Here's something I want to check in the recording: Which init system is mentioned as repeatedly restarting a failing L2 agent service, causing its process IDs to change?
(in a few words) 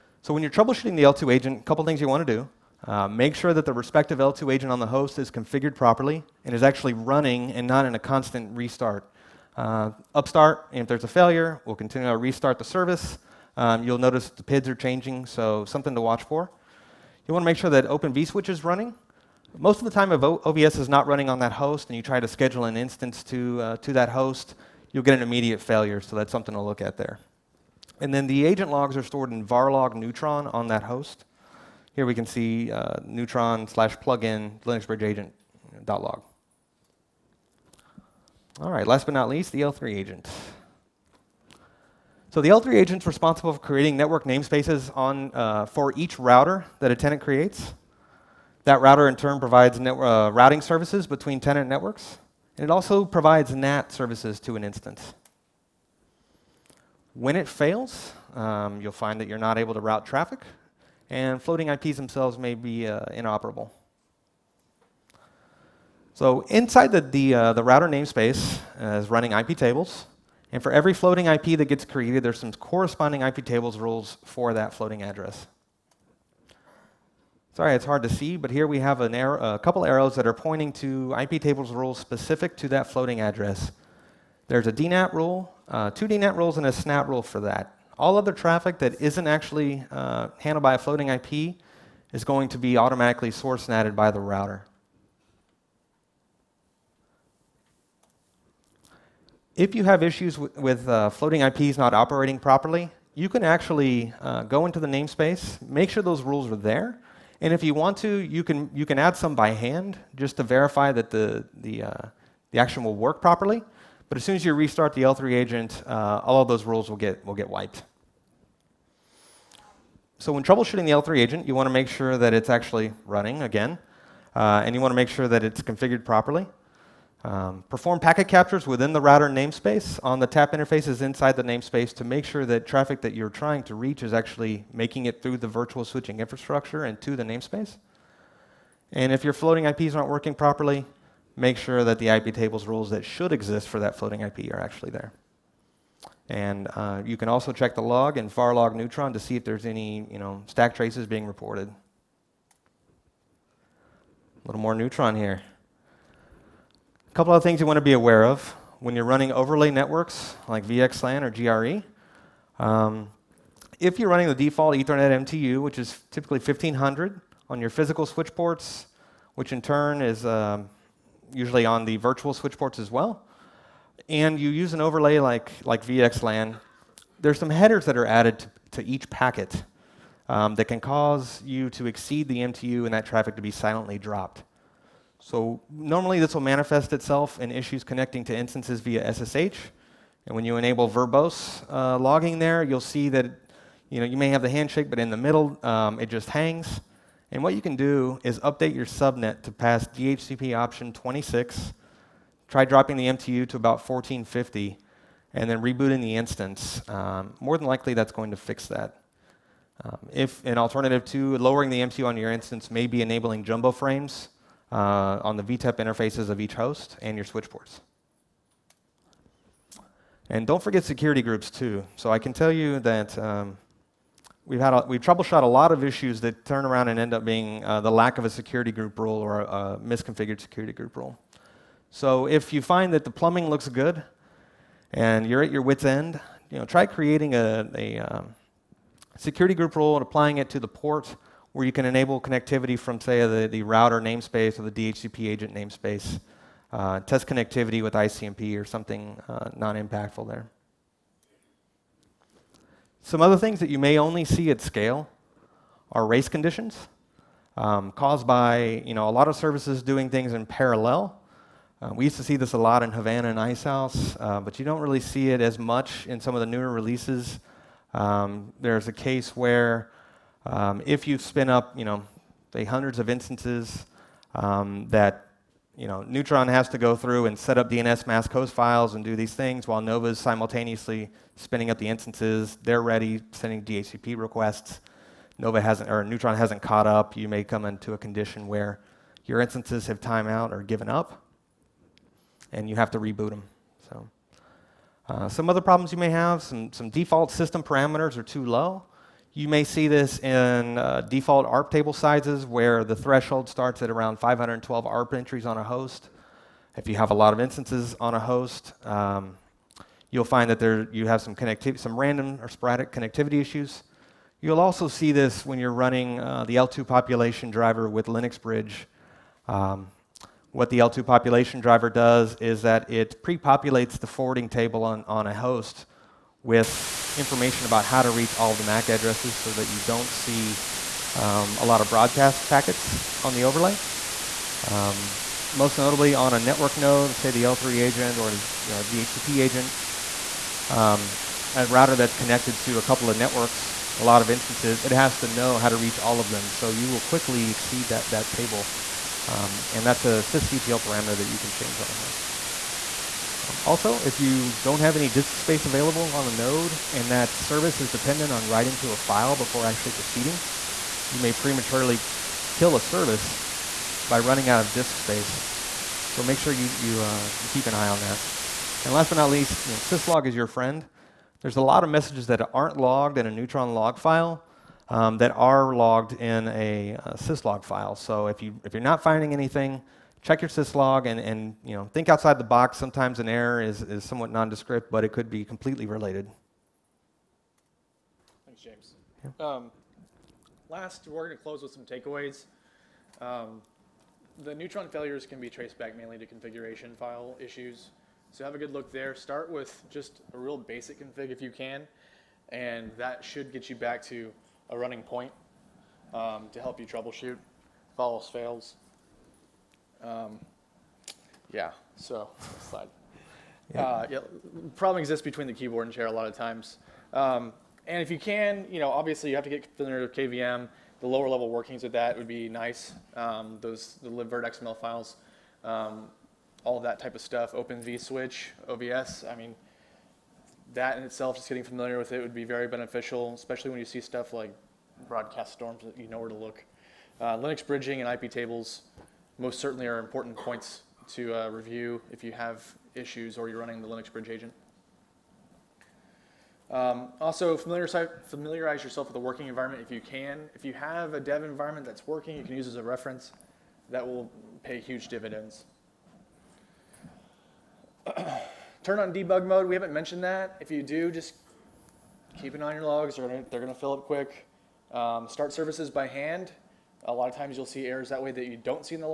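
Upstart.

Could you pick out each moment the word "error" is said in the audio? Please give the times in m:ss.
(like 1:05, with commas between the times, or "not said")
6:23, 7:47.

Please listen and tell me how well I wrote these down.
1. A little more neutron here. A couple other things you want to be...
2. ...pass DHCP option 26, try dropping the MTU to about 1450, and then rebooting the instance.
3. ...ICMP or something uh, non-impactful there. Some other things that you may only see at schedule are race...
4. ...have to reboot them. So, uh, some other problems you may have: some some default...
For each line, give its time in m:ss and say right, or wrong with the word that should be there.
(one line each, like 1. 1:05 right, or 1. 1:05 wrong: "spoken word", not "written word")
1. 2:31 right
2. 3:19 right
3. 4:07 wrong: "scale", not "schedule"
4. 4:52 right.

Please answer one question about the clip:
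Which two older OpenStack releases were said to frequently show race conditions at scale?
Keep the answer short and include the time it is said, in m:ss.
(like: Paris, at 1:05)
Havana and Icehouse, at 4:22.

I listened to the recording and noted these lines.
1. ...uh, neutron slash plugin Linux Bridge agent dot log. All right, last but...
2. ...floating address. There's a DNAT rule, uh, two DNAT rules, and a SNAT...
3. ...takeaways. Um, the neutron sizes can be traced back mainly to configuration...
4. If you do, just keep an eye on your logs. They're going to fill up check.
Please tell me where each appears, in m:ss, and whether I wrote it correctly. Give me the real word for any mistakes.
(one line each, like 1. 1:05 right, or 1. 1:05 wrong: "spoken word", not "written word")
1. 0:32 right
2. 1:22 right
3. 6:31 wrong: "failures", not "sizes"
4. 7:40 wrong: "quick", not "check".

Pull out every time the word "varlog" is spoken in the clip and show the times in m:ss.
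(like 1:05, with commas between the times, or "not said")
0:29, 2:28.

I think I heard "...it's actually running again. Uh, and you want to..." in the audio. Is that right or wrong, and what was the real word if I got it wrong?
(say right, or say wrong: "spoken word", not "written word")
right.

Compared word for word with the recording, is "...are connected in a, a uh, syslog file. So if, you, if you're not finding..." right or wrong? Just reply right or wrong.
wrong.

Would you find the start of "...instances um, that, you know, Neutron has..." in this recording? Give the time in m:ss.
4:33.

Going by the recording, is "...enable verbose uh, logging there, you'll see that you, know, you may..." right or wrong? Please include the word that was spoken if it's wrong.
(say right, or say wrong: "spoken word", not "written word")
right.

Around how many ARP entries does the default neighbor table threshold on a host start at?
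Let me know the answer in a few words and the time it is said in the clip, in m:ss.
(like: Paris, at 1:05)
512, at 5:04.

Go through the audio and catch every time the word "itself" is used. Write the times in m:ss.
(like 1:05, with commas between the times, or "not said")
3:06, 7:11.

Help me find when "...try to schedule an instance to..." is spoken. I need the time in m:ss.
0:22.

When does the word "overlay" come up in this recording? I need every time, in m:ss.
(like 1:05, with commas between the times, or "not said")
2:39, 2:54, 5:33.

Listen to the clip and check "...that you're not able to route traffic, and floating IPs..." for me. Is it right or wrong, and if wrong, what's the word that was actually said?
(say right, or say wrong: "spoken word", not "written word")
right.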